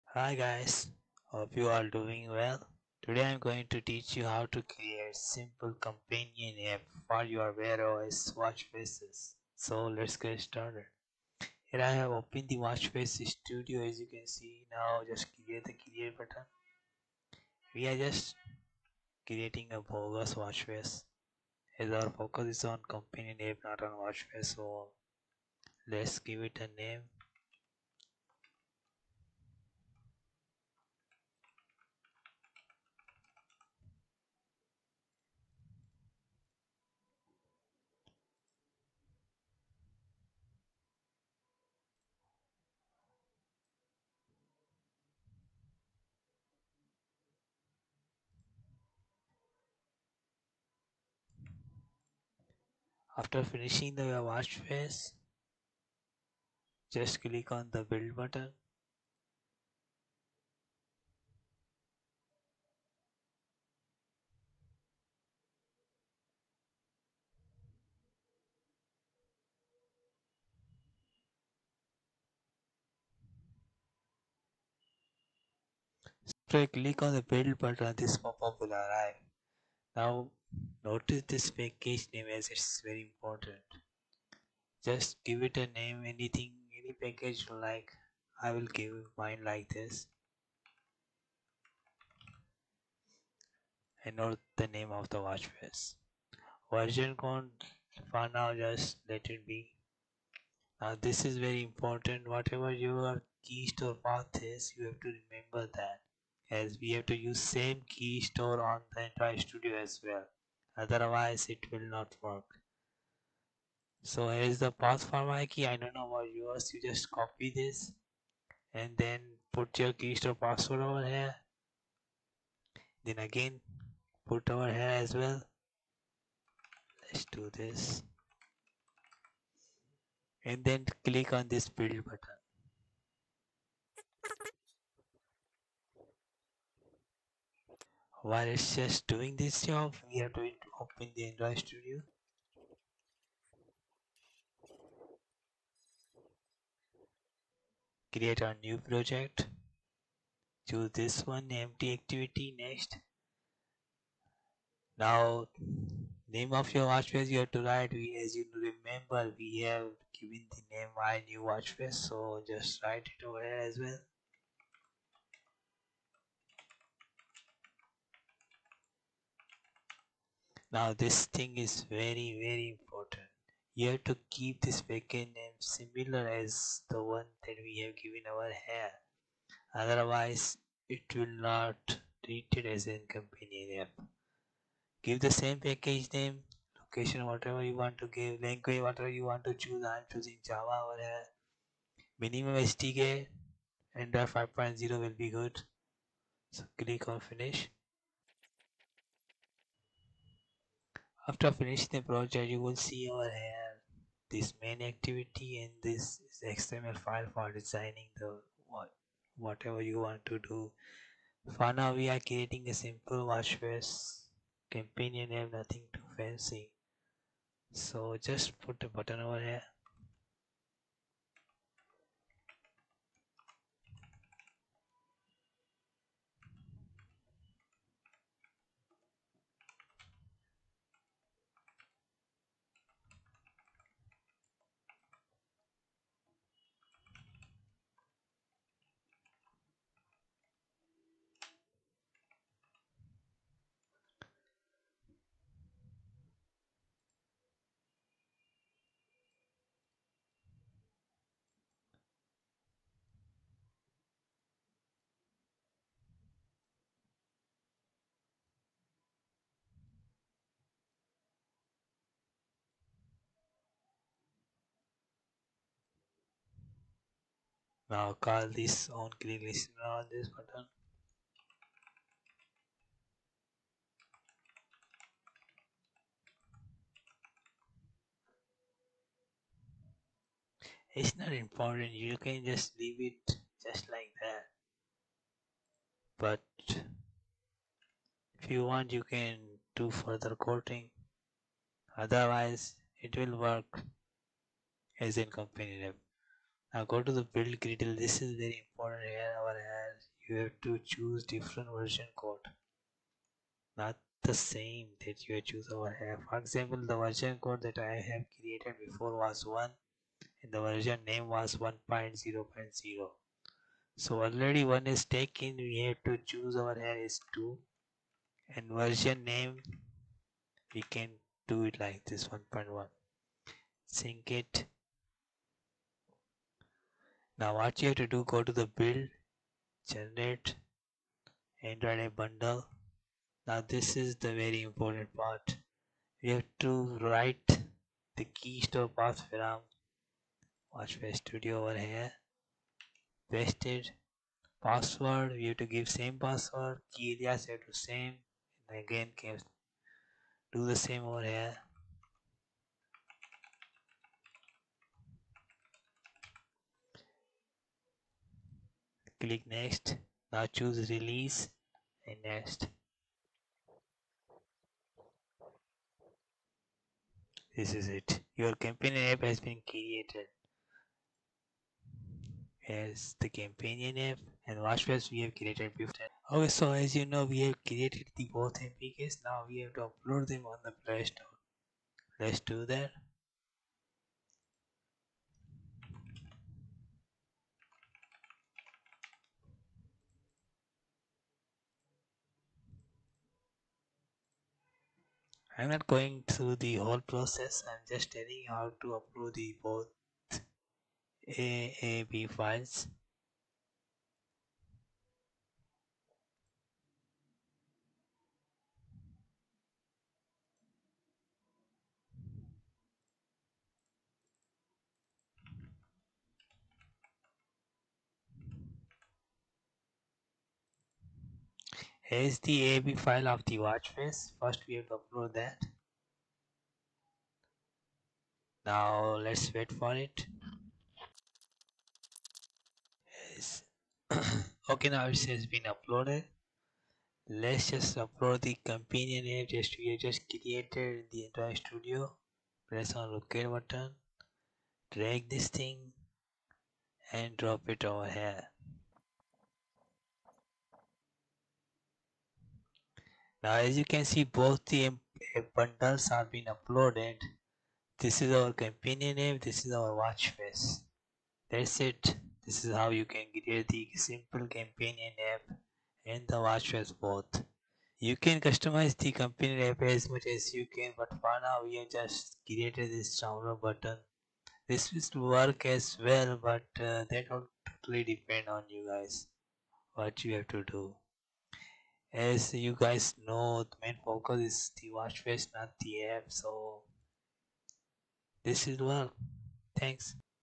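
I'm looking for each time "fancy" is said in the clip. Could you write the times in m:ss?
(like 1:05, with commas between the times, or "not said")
3:36.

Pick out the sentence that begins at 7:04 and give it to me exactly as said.
First we have to upload that.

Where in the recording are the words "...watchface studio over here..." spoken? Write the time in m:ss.
5:40.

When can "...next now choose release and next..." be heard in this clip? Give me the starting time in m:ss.
5:59.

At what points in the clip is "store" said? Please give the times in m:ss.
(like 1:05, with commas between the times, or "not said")
1:43, 1:48, 2:00, 5:38, 6:21.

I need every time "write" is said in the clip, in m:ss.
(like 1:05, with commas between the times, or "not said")
2:37, 2:42, 5:37.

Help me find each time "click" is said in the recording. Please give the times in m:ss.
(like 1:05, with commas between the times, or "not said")
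0:57, 1:16, 2:11, 3:16, 5:59.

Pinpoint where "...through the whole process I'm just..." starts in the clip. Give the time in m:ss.
6:36.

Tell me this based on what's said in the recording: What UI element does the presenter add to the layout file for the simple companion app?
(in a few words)
A button.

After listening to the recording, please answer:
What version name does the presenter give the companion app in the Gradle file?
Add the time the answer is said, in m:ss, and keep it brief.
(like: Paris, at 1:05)
1.1, at 5:22.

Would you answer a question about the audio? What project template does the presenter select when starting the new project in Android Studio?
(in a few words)
Empty activity.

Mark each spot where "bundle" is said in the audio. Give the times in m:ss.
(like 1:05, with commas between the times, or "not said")
5:32, 7:35.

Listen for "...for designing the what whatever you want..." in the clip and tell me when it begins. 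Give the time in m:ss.
3:27.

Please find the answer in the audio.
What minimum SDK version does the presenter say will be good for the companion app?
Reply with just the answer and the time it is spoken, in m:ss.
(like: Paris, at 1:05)
5.0, at 3:14.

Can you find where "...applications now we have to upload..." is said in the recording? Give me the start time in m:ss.
6:18.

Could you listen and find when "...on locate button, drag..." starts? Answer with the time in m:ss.
7:22.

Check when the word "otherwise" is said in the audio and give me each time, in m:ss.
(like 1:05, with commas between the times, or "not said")
1:50, 2:59, 4:51.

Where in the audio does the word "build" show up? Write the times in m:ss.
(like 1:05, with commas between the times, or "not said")
0:57, 1:17, 2:11, 4:57, 5:28.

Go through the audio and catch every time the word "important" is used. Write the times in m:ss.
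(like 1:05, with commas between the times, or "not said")
1:23, 1:41, 2:52, 4:41, 4:58, 5:34.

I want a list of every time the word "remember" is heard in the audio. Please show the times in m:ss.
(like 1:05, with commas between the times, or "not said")
1:45, 2:38.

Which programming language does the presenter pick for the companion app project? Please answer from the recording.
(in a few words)
Java.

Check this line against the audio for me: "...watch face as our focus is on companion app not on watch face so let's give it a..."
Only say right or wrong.
right.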